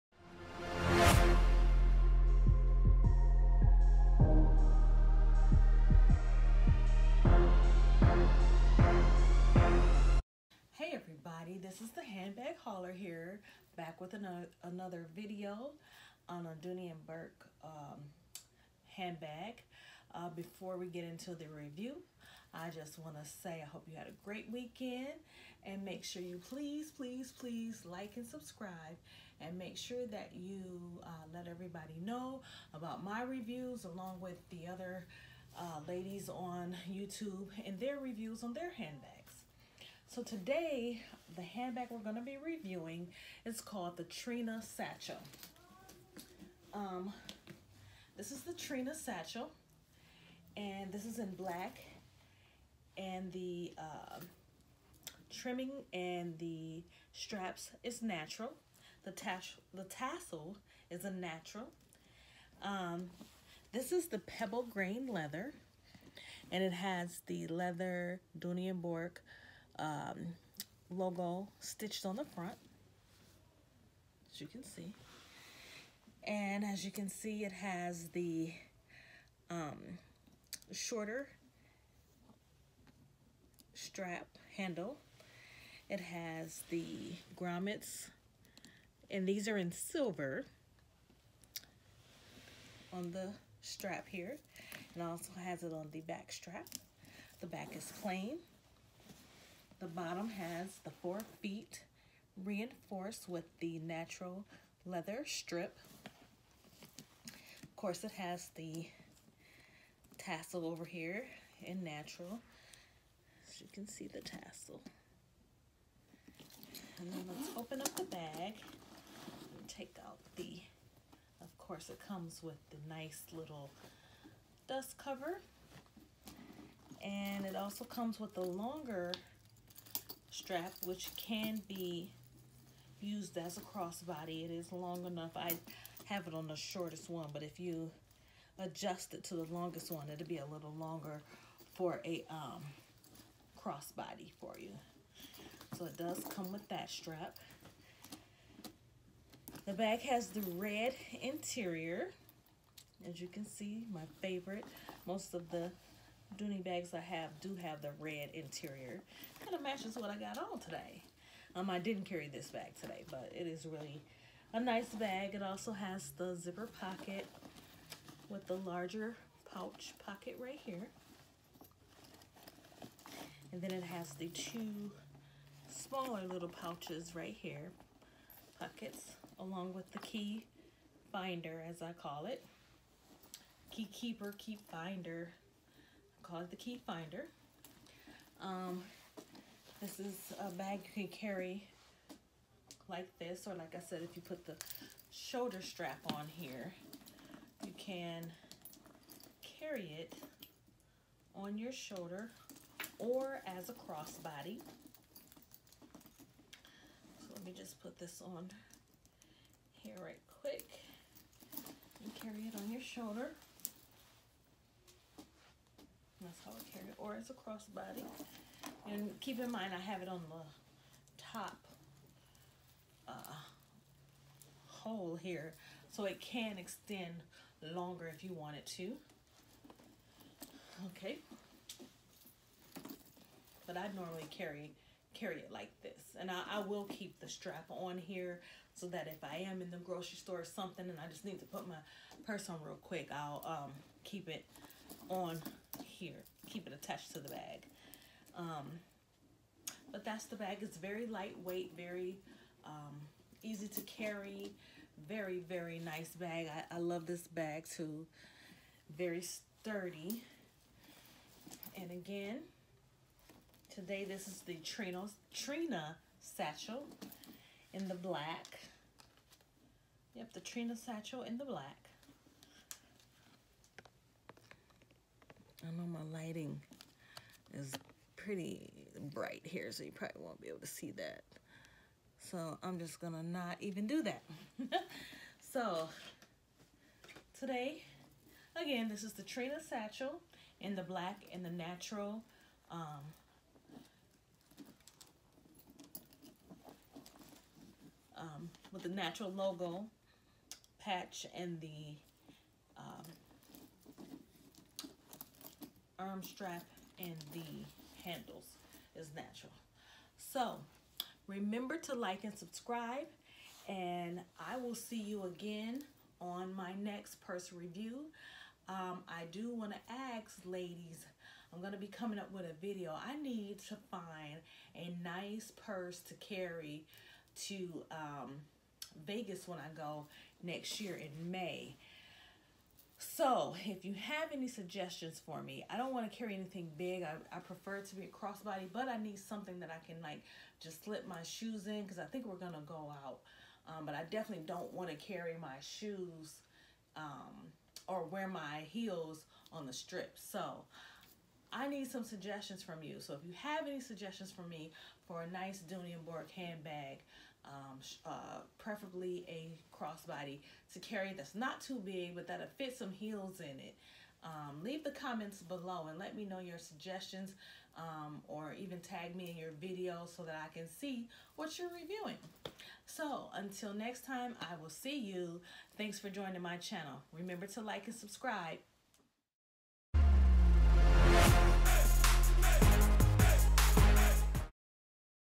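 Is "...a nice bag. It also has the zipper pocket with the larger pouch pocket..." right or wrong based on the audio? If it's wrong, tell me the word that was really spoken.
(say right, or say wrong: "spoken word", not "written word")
right.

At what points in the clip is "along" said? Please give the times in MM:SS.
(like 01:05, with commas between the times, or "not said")
00:33, 02:59.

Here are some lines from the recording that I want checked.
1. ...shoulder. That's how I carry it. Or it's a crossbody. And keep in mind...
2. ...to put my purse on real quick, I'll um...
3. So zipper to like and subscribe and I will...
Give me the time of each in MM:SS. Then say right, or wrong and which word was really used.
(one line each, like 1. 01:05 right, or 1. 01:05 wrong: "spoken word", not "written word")
1. 03:32 right
2. 04:01 right
3. 05:10 wrong: "remember", not "zipper".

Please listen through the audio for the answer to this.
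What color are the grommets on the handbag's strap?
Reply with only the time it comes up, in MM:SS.
01:29.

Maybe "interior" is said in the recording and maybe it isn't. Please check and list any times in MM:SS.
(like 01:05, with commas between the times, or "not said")
02:31, 02:38.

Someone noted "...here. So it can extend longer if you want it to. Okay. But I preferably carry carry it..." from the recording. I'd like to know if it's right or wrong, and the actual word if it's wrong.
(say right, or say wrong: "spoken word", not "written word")
wrong: "normally", not "preferably".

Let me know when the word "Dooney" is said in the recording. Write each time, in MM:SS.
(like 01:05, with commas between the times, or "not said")
00:16, 01:08, 02:36, 05:55.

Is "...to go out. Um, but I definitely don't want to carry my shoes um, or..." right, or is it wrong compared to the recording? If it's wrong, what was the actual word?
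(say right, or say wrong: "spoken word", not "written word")
right.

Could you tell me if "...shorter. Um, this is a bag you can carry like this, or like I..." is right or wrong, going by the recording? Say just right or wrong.
wrong.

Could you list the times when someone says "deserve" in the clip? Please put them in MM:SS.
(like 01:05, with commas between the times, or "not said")
not said.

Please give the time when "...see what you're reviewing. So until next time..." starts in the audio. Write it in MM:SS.
06:10.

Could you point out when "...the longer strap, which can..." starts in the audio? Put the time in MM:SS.
02:08.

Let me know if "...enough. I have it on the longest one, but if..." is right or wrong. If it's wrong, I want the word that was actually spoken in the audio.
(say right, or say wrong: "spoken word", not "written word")
wrong: "shortest", not "longest".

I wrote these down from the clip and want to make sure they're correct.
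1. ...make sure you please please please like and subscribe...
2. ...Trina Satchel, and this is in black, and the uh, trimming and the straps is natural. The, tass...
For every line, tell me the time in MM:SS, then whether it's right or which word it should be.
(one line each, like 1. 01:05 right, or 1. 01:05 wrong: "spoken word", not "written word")
1. 00:25 right
2. 00:48 right.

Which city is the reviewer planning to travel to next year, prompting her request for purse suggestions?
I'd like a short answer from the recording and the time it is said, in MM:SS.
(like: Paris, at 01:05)
Vegas, at 05:29.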